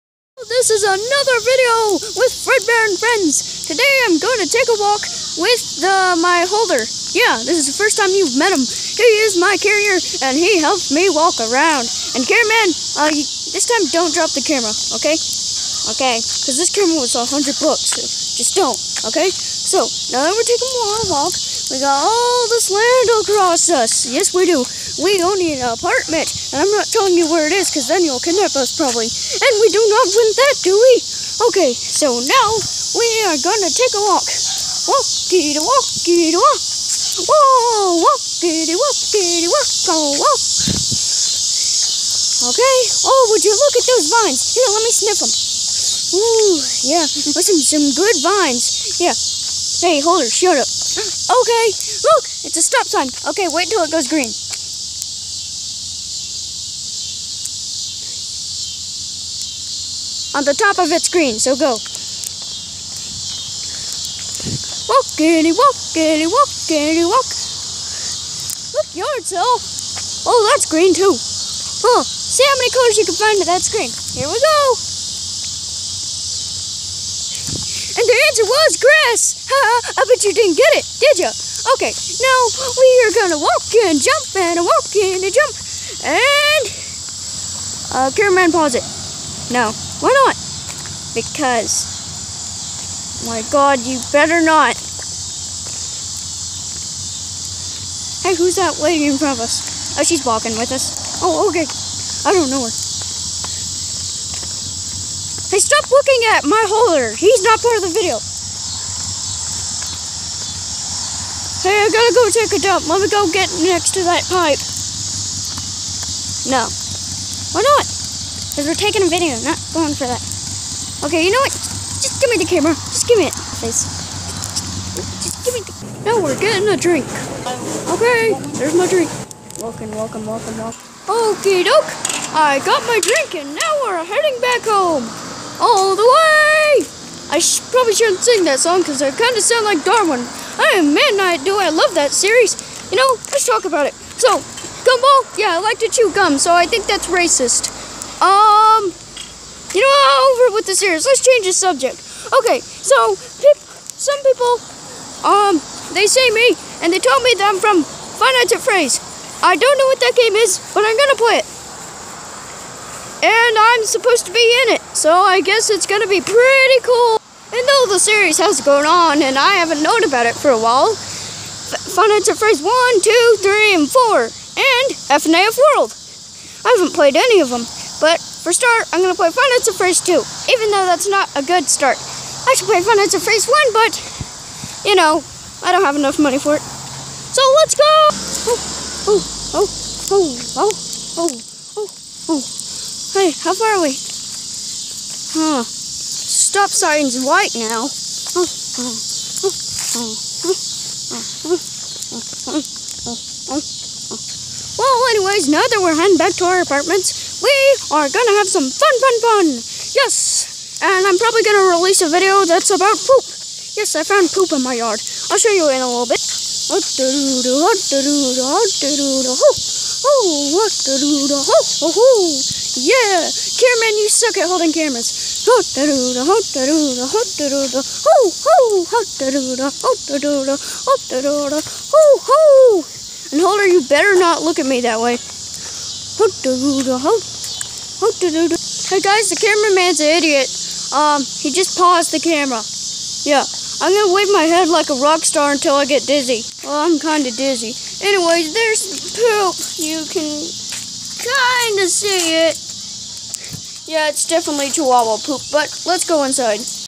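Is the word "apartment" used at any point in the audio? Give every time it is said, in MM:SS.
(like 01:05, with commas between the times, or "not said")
00:25, 03:26.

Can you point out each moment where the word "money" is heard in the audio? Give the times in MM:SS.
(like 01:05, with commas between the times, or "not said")
03:06.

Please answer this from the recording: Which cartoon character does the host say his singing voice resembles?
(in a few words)
Darwin.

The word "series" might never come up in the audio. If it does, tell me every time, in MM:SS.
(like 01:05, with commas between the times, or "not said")
02:22, 02:30, 02:47.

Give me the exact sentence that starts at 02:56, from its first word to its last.
I haven't played any of them.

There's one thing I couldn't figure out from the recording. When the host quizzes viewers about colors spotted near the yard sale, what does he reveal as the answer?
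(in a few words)
grass.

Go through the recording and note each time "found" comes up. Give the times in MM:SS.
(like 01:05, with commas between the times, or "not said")
03:34.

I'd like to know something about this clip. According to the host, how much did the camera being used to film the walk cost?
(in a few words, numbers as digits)
$100.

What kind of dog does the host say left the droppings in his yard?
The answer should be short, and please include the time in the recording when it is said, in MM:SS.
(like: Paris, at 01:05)
chihuahua, at 04:14.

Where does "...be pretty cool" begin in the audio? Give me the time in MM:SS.
02:46.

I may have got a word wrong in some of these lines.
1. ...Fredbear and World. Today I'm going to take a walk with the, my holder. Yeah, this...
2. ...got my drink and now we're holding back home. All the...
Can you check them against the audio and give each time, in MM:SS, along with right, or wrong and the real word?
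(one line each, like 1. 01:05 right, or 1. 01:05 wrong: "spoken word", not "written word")
1. 00:02 wrong: "Friends", not "World"
2. 02:12 wrong: "heading", not "holding".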